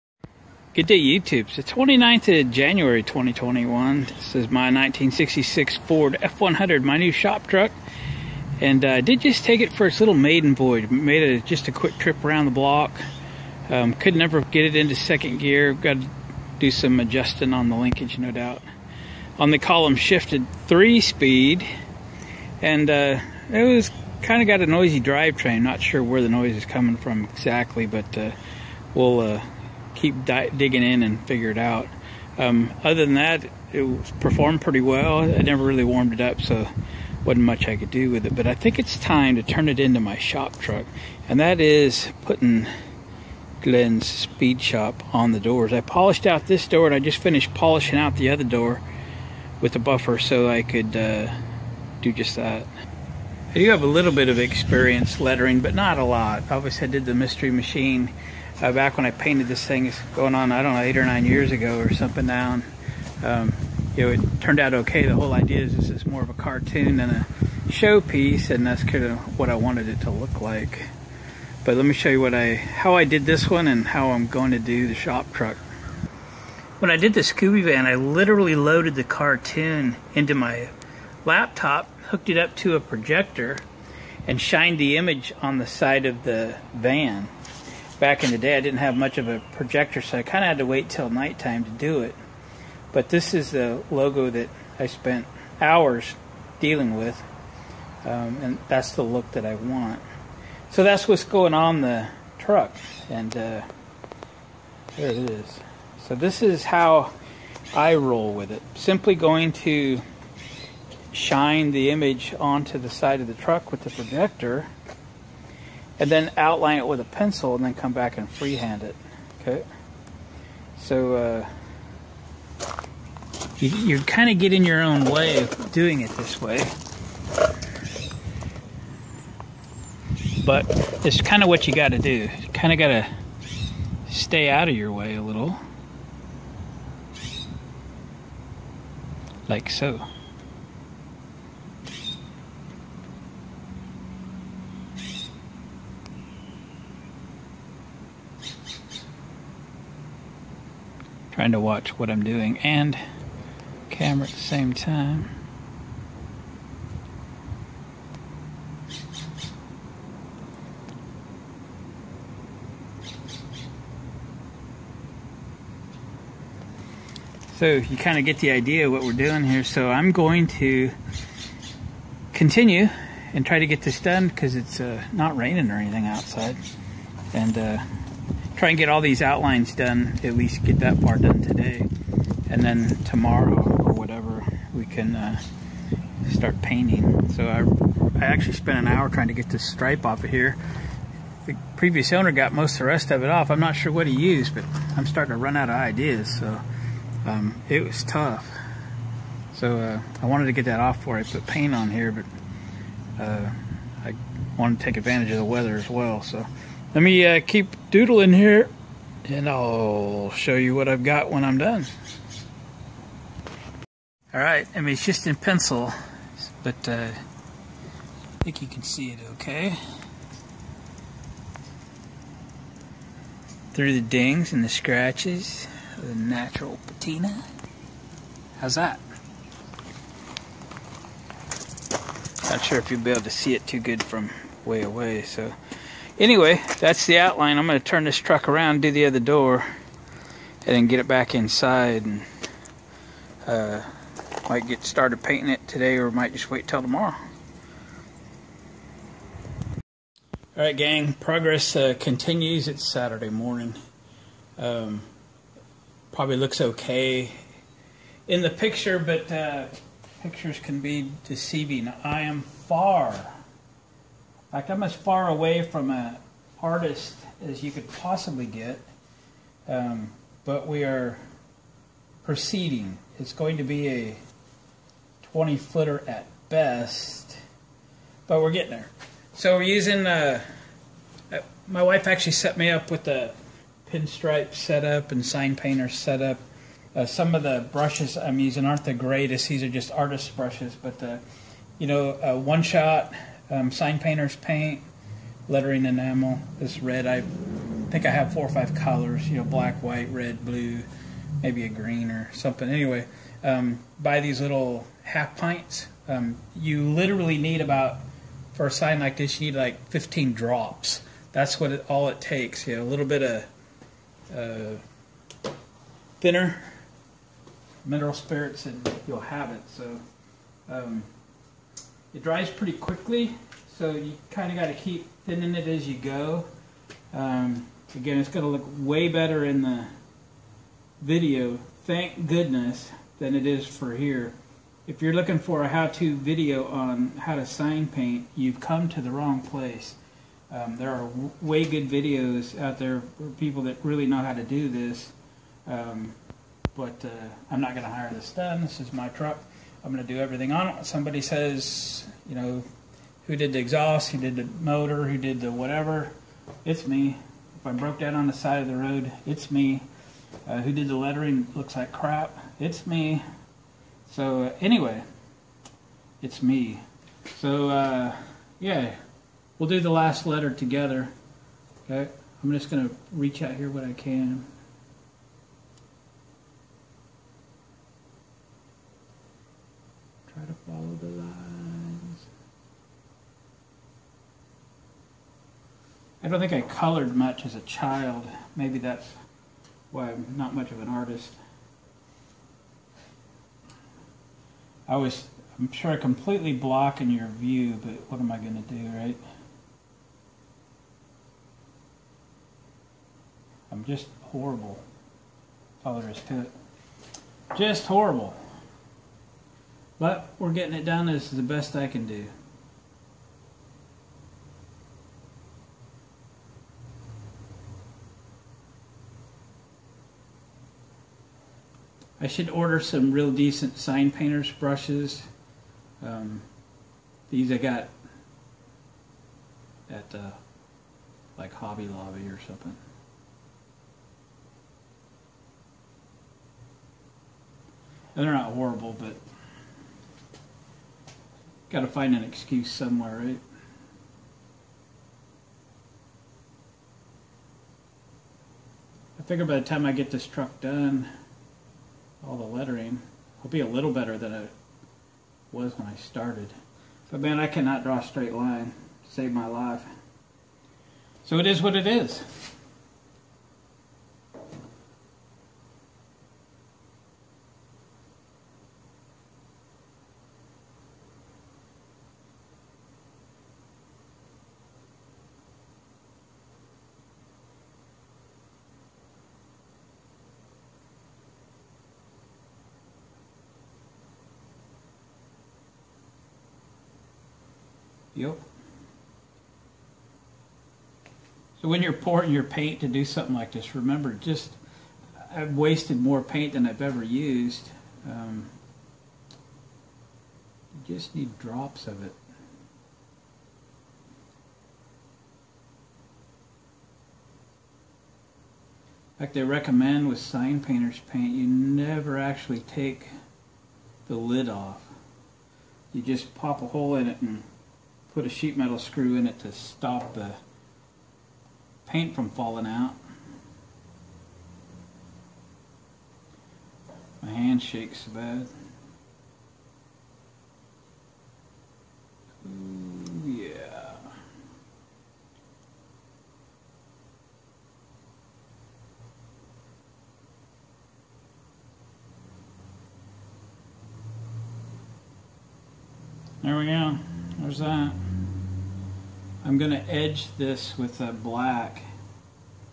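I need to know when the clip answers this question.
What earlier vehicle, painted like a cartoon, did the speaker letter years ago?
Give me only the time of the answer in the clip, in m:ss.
0:57.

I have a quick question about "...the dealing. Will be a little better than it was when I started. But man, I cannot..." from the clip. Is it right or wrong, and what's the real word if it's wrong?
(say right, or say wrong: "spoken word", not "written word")
wrong: "lettering", not "dealing".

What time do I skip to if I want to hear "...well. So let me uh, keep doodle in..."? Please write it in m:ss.
3:25.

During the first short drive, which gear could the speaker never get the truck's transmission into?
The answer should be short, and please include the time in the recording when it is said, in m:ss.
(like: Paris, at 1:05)
second gear, at 0:14.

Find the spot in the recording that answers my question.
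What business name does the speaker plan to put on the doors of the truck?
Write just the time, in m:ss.
0:43.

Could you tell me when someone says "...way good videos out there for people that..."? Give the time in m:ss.
5:41.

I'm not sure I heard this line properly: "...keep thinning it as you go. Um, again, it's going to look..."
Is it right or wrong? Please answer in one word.
right.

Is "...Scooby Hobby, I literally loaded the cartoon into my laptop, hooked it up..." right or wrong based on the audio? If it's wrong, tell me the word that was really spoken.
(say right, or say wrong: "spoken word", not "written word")
wrong: "Van", not "Hobby".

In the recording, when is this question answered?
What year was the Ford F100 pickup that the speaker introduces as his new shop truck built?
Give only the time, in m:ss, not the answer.
0:04.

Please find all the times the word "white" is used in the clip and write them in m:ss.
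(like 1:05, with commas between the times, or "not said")
4:59.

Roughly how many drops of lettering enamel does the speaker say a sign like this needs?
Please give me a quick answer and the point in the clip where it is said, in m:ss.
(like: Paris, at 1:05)
15, at 5:09.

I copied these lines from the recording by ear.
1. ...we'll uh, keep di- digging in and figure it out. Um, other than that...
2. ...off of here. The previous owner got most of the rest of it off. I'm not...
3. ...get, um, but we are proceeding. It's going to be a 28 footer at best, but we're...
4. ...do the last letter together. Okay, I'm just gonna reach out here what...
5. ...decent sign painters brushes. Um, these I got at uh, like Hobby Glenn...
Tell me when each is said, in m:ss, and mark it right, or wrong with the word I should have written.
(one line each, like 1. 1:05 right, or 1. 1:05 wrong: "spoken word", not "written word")
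1. 0:28 right
2. 3:10 right
3. 4:28 wrong: "20", not "28"
4. 6:09 right
5. 7:03 wrong: "Lobby", not "Glenn".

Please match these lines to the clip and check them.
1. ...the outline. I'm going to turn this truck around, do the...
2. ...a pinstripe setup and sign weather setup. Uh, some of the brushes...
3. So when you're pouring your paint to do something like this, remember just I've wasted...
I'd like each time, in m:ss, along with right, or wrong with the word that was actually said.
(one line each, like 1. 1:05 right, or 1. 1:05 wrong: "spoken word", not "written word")
1. 3:57 right
2. 4:43 wrong: "painter", not "weather"
3. 8:11 right.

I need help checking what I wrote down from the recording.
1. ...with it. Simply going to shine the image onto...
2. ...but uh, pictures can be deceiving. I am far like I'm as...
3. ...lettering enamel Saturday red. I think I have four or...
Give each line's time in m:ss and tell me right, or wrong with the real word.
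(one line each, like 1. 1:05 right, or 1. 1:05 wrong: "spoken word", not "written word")
1. 1:48 right
2. 4:18 right
3. 4:55 wrong: "This", not "Saturday".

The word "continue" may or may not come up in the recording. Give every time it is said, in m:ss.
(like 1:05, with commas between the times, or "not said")
2:52, 4:11.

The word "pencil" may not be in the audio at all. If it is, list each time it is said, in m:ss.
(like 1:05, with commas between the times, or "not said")
1:57, 3:35.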